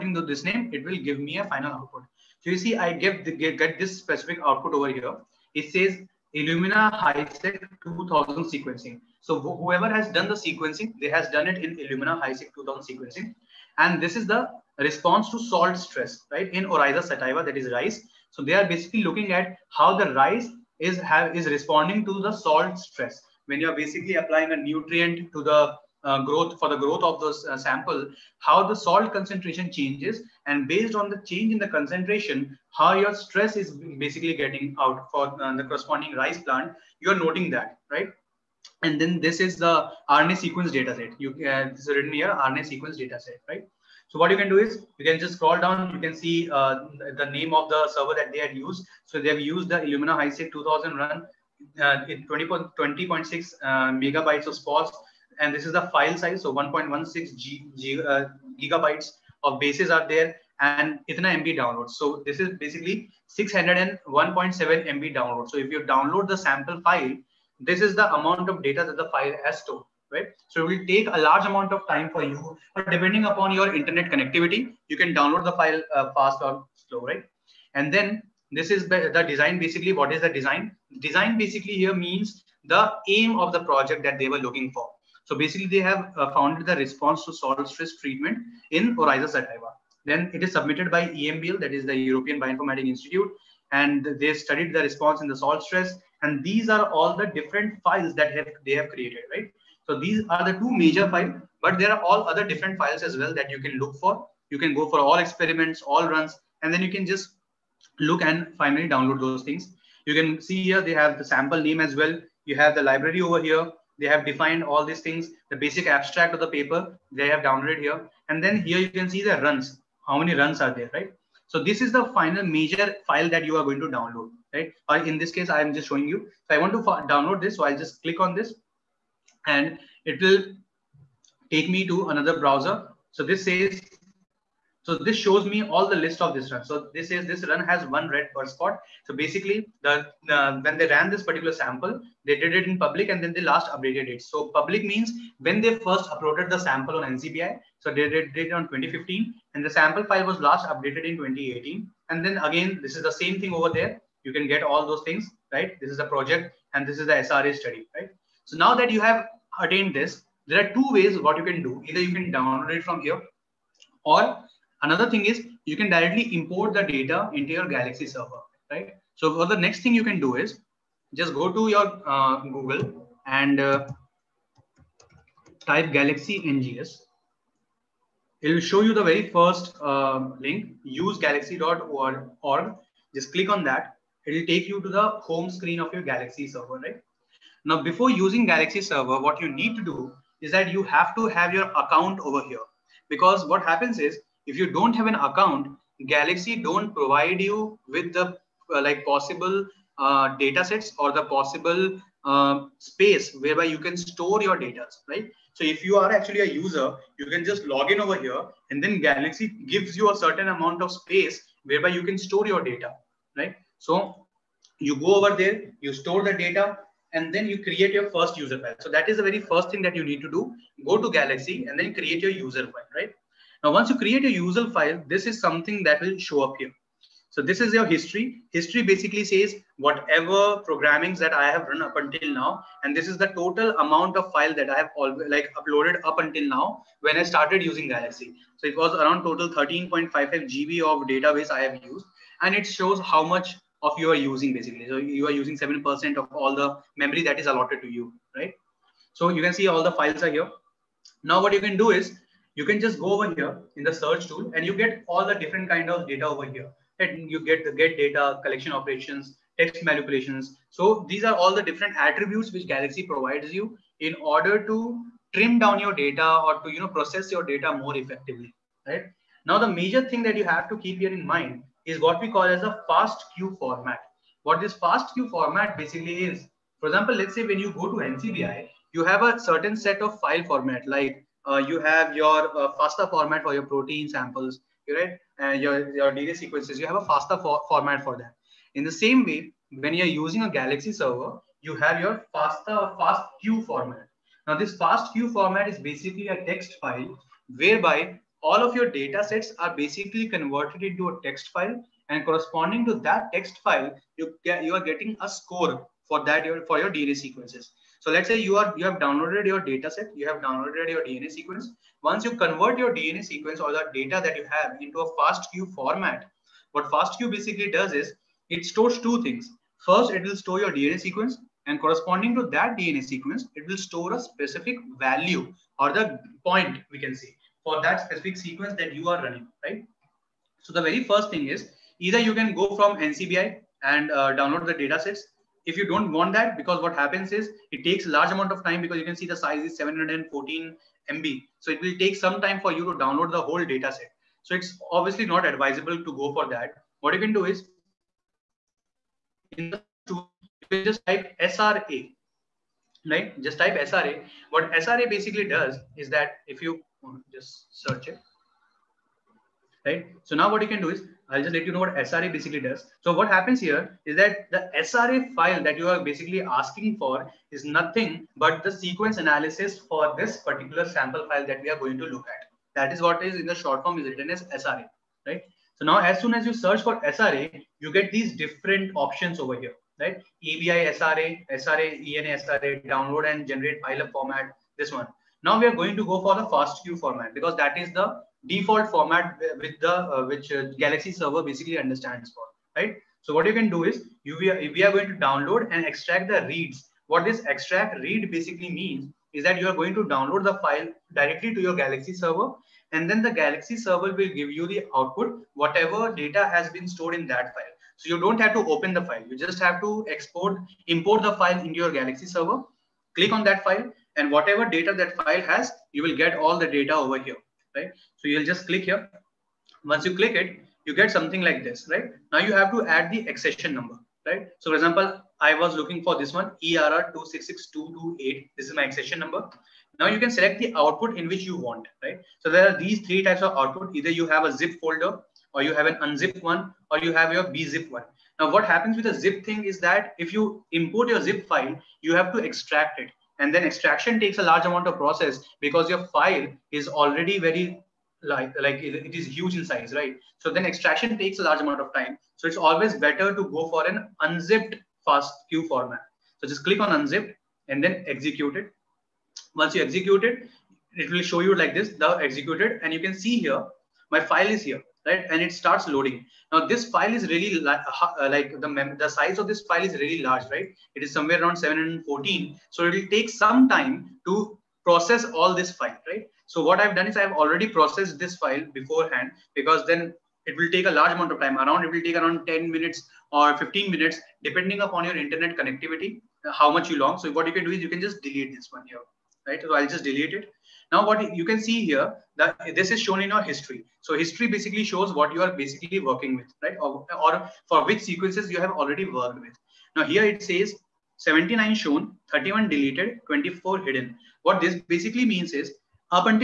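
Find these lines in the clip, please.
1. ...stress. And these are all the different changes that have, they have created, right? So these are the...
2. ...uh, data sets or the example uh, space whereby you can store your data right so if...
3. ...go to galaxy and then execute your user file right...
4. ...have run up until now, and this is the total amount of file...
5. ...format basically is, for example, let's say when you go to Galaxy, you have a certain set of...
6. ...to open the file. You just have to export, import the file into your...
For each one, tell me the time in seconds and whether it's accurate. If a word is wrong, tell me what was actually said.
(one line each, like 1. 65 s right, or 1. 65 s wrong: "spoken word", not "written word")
1. 95 s wrong: "files", not "changes"
2. 199 s wrong: "possible", not "example"
3. 220 s wrong: "create", not "execute"
4. 231 s right
5. 275 s wrong: "NCBI", not "Galaxy"
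6. 408 s right.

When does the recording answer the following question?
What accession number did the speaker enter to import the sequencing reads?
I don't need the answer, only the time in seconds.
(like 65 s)
426 s.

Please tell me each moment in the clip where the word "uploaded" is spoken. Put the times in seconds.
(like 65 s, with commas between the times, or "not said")
146 s, 235 s.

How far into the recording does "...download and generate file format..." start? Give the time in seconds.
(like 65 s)
382 s.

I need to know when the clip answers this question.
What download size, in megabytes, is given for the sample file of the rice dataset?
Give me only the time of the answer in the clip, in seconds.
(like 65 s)
63 s.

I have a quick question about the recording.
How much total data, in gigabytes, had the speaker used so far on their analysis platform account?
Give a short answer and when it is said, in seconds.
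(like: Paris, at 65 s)
13.55 GB, at 239 s.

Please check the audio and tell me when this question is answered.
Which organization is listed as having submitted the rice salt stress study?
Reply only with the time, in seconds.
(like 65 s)
91 s.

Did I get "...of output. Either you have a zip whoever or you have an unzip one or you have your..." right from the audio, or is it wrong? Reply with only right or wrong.
wrong.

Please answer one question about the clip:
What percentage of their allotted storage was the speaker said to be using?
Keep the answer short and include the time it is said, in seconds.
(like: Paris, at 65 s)
7%, at 245 s.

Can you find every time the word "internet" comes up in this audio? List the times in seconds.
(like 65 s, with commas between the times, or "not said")
73 s, 485 s.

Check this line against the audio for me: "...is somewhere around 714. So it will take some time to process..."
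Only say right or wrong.
right.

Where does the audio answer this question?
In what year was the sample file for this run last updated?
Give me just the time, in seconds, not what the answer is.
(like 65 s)
151 s.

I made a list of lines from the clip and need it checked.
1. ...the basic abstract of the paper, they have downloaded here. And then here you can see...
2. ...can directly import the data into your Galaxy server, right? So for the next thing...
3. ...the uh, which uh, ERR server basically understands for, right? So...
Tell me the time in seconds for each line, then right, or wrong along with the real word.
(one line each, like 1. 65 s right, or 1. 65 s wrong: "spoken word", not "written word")
1. 115 s right
2. 165 s right
3. 389 s wrong: "Galaxy", not "ERR".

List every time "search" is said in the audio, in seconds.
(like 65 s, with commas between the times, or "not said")
253 s, 357 s, 376 s.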